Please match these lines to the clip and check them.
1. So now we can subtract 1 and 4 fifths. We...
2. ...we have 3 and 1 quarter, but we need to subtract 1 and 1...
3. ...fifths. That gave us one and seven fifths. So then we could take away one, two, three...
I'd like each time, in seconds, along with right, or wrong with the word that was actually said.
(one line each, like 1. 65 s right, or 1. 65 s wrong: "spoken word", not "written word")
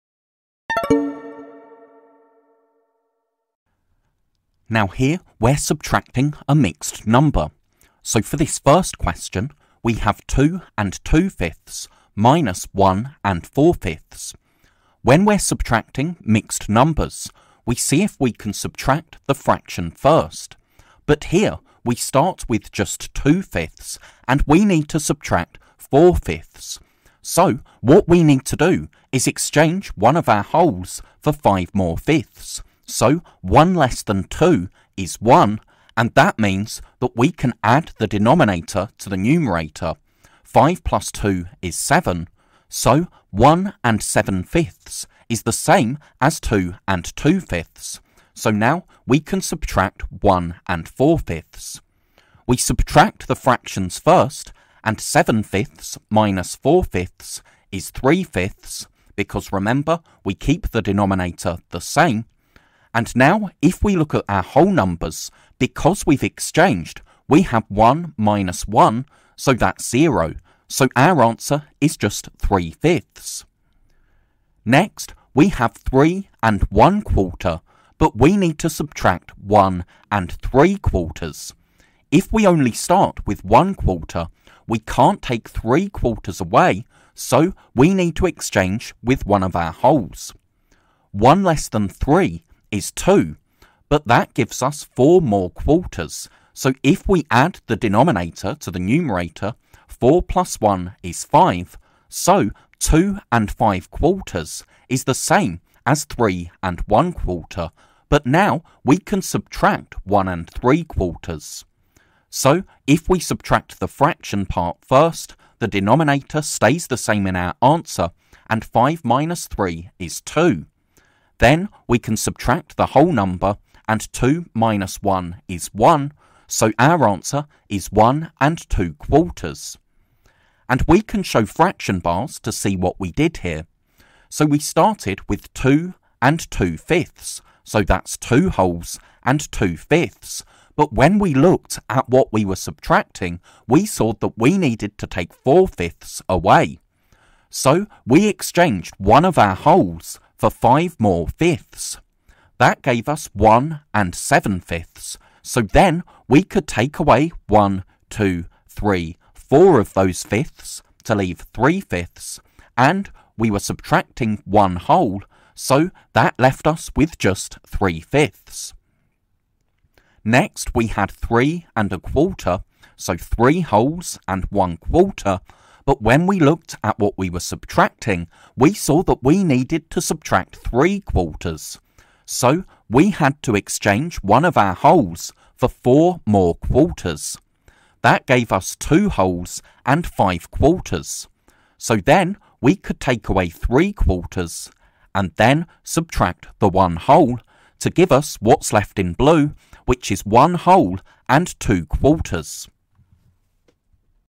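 1. 48 s right
2. 75 s wrong: "3", not "1"
3. 151 s right.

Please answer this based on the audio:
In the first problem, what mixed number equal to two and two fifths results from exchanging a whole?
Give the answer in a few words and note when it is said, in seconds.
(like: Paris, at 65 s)
1 and 7/5, at 43 s.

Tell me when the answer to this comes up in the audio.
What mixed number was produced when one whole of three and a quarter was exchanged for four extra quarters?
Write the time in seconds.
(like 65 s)
102 s.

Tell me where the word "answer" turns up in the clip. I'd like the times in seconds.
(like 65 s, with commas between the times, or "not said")
71 s, 117 s, 127 s.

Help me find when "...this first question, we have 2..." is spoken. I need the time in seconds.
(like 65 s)
8 s.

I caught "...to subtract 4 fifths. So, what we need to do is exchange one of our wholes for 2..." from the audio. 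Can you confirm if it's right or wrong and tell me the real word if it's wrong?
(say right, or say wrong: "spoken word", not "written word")
wrong: "5", not "2".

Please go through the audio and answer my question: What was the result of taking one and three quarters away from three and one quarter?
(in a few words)
1 and 2/4.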